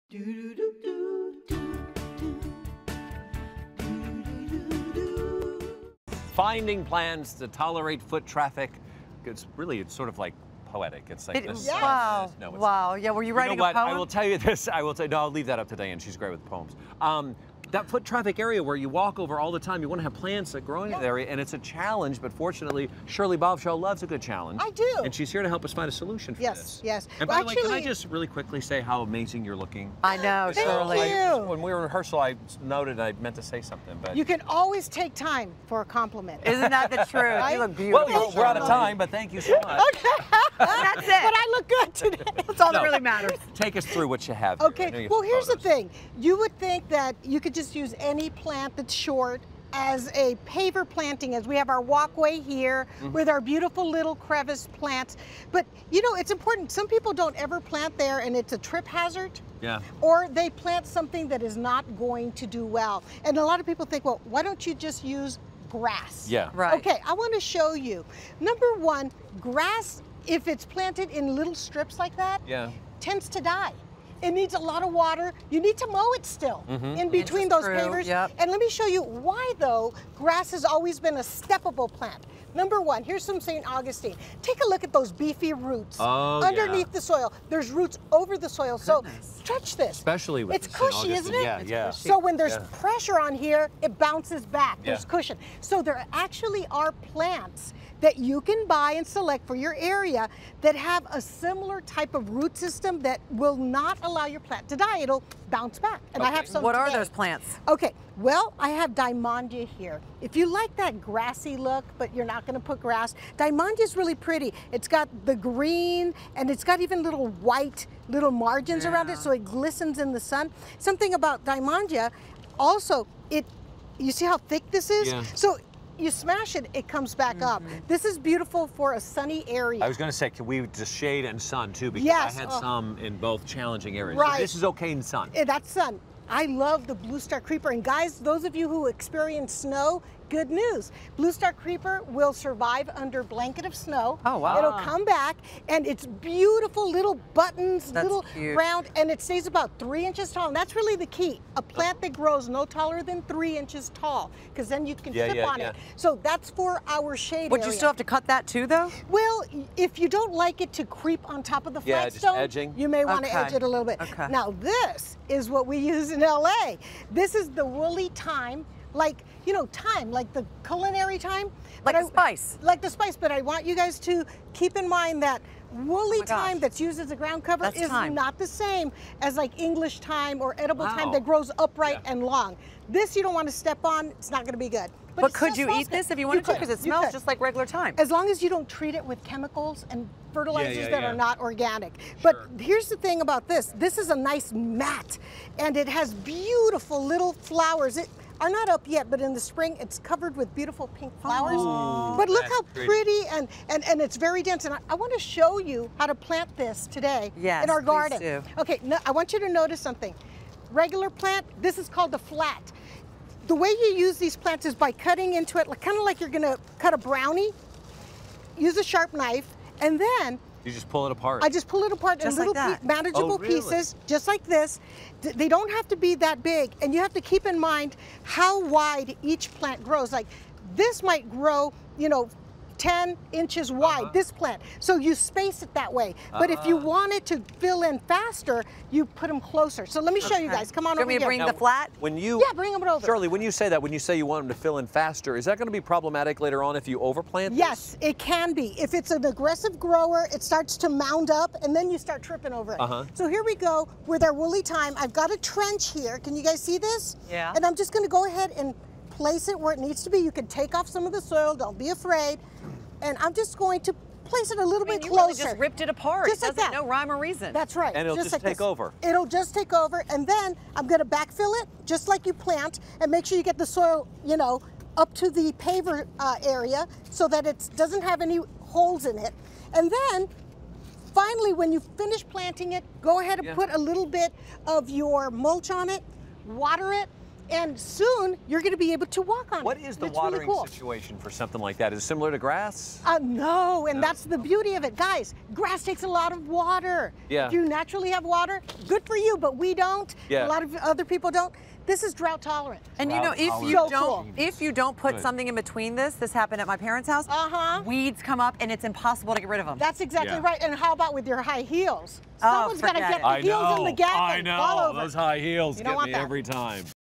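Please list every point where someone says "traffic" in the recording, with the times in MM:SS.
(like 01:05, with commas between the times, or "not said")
00:08, 00:18.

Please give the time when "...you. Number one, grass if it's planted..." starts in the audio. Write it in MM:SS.
01:07.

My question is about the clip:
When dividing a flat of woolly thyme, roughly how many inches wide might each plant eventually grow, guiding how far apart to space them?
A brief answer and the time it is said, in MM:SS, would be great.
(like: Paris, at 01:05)
10 inches, at 03:52.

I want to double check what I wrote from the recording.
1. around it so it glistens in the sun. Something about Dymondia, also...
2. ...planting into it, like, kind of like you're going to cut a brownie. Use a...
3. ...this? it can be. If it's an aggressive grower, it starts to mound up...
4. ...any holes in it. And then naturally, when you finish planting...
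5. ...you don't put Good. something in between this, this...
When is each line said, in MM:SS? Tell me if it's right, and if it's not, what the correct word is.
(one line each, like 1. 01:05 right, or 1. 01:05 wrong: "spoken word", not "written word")
1. 01:58 right
2. 03:34 wrong: "cutting", not "planting"
3. 04:07 right
4. 04:38 wrong: "finally", not "naturally"
5. 05:04 right.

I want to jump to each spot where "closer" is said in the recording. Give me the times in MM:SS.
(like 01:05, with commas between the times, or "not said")
03:59, 04:25.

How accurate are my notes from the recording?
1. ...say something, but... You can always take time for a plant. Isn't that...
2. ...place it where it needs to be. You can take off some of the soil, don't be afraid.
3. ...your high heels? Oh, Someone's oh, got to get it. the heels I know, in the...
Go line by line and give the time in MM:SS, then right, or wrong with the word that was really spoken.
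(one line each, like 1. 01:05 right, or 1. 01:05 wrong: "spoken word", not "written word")
1. 00:33 wrong: "compliment", not "plant"
2. 04:19 right
3. 05:11 right.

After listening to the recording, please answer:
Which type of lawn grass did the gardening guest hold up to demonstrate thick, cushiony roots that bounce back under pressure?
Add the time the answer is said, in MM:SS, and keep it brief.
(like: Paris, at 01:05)
St. Augustine, at 01:23.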